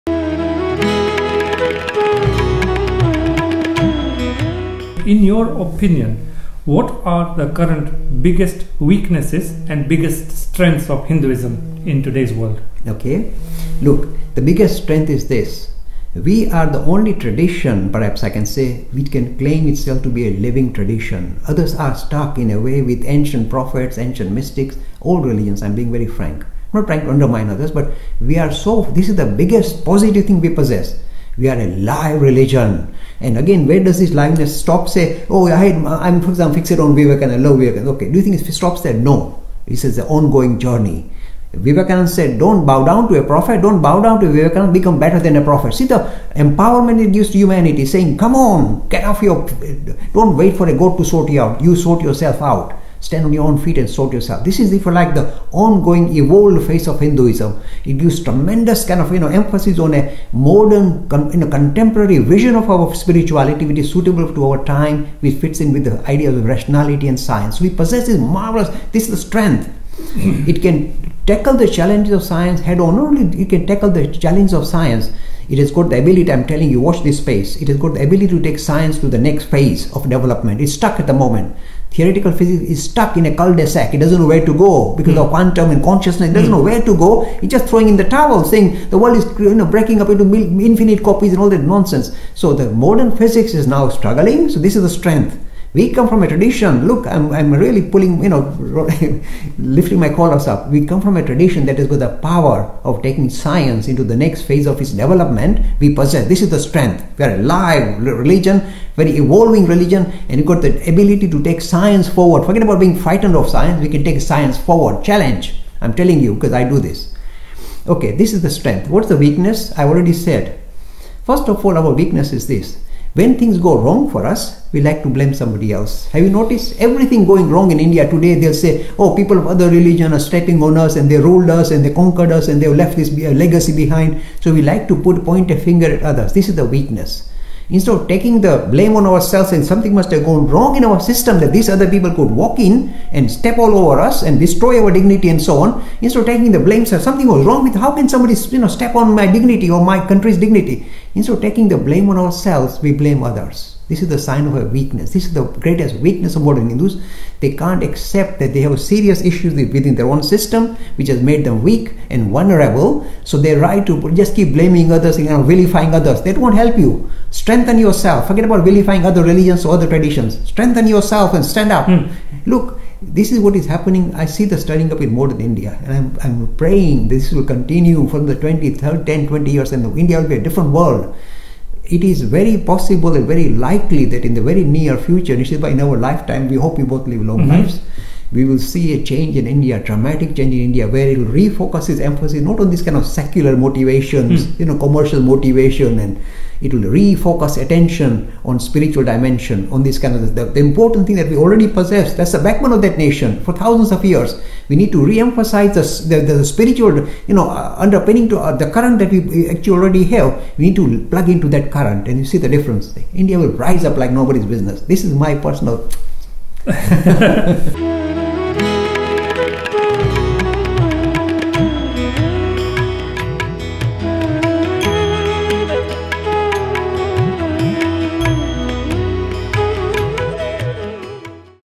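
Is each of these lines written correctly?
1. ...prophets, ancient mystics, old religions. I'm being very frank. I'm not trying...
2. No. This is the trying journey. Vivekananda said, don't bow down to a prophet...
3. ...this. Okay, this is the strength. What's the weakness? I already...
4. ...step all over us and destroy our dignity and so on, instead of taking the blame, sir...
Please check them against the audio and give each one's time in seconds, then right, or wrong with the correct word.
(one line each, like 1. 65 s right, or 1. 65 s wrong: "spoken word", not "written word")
1. 23 s right
2. 38 s wrong: "ongoing", not "trying"
3. 116 s right
4. 143 s right.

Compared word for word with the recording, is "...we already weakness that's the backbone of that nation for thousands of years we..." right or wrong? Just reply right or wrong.
wrong.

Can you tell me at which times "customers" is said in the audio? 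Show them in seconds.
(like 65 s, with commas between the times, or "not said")
not said.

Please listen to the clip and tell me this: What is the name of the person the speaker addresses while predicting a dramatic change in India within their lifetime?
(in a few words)
Nishiba.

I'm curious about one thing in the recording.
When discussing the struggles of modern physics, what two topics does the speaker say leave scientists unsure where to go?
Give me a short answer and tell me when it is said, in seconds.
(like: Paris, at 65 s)
quantum and consciousness, at 85 s.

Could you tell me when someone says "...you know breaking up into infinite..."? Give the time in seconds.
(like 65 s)
89 s.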